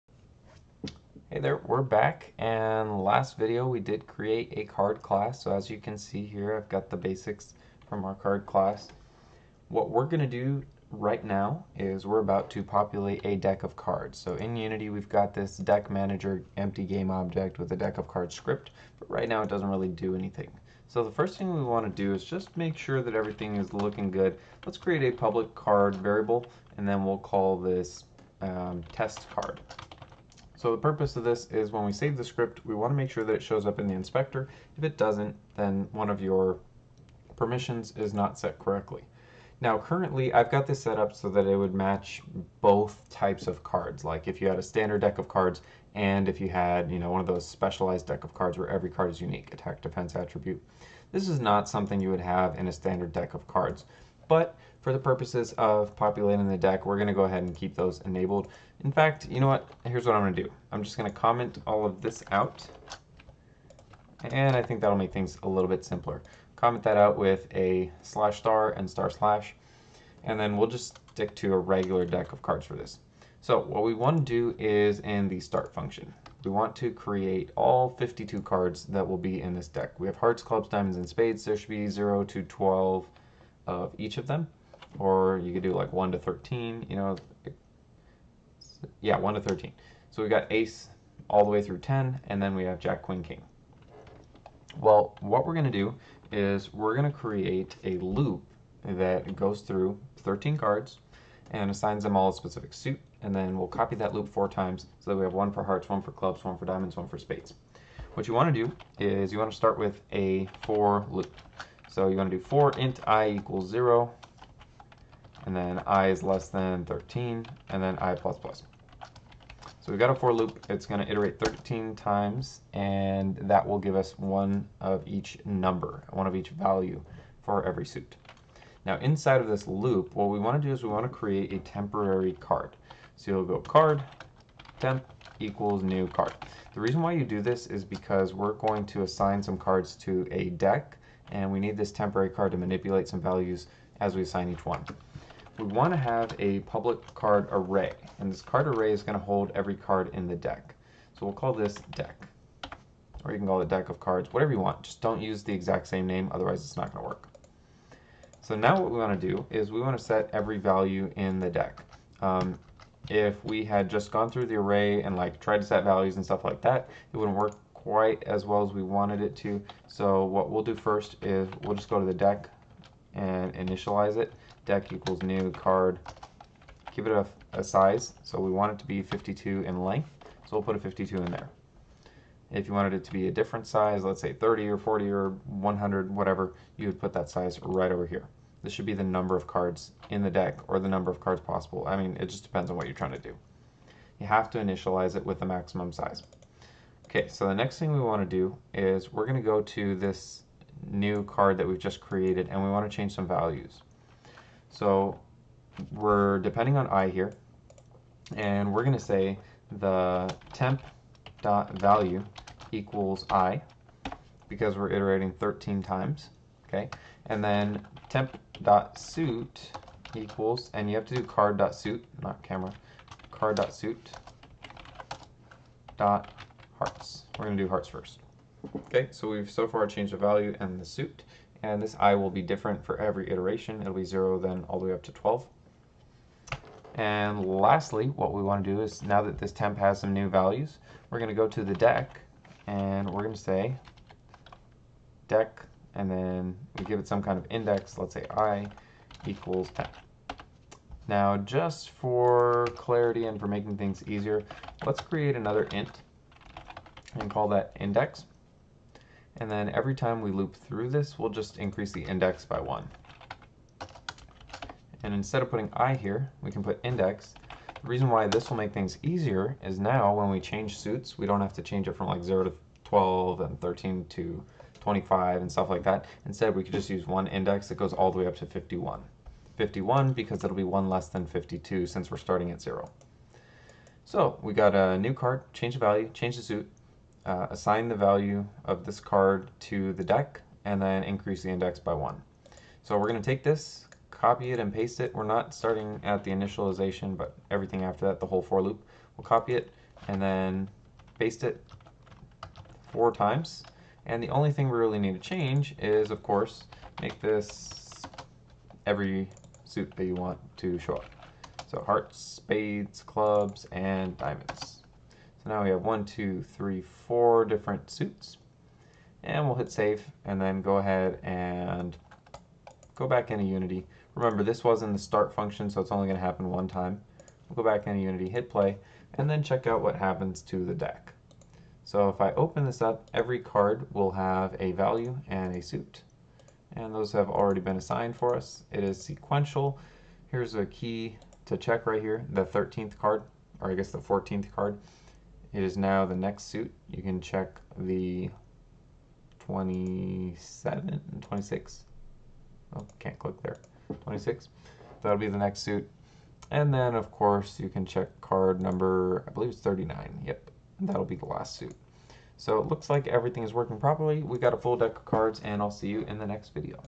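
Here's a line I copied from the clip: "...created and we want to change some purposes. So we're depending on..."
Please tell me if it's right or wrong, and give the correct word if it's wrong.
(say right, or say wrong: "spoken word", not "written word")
wrong: "values", not "purposes".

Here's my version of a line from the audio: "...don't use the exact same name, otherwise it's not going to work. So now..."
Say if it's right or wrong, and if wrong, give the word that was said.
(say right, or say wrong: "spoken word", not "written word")
right.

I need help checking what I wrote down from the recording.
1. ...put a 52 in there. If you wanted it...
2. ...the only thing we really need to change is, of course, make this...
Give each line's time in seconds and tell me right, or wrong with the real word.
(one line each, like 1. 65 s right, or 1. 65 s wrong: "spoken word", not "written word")
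1. 180 s right
2. 304 s right.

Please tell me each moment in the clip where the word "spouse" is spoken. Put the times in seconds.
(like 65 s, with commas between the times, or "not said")
not said.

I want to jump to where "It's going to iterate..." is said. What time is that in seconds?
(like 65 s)
120 s.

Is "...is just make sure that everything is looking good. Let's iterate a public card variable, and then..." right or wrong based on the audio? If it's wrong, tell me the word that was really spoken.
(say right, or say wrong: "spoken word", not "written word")
wrong: "create", not "iterate".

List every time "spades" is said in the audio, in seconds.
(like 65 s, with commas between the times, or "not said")
81 s, 107 s, 312 s.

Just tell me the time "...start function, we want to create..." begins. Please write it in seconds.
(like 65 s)
75 s.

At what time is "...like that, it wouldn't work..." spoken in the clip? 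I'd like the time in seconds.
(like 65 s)
166 s.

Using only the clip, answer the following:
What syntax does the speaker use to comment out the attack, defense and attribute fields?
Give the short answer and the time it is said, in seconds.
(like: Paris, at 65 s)
slash star and star slash, at 68 s.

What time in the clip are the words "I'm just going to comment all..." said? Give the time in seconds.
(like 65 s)
60 s.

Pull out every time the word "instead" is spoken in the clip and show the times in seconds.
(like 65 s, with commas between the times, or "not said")
265 s, 276 s.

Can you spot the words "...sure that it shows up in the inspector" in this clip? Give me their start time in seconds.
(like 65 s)
33 s.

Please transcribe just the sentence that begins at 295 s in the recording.
We're not starting at the initialization, but everything after that, the whole for loop.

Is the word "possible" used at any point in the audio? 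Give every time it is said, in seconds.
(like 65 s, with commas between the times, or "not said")
191 s.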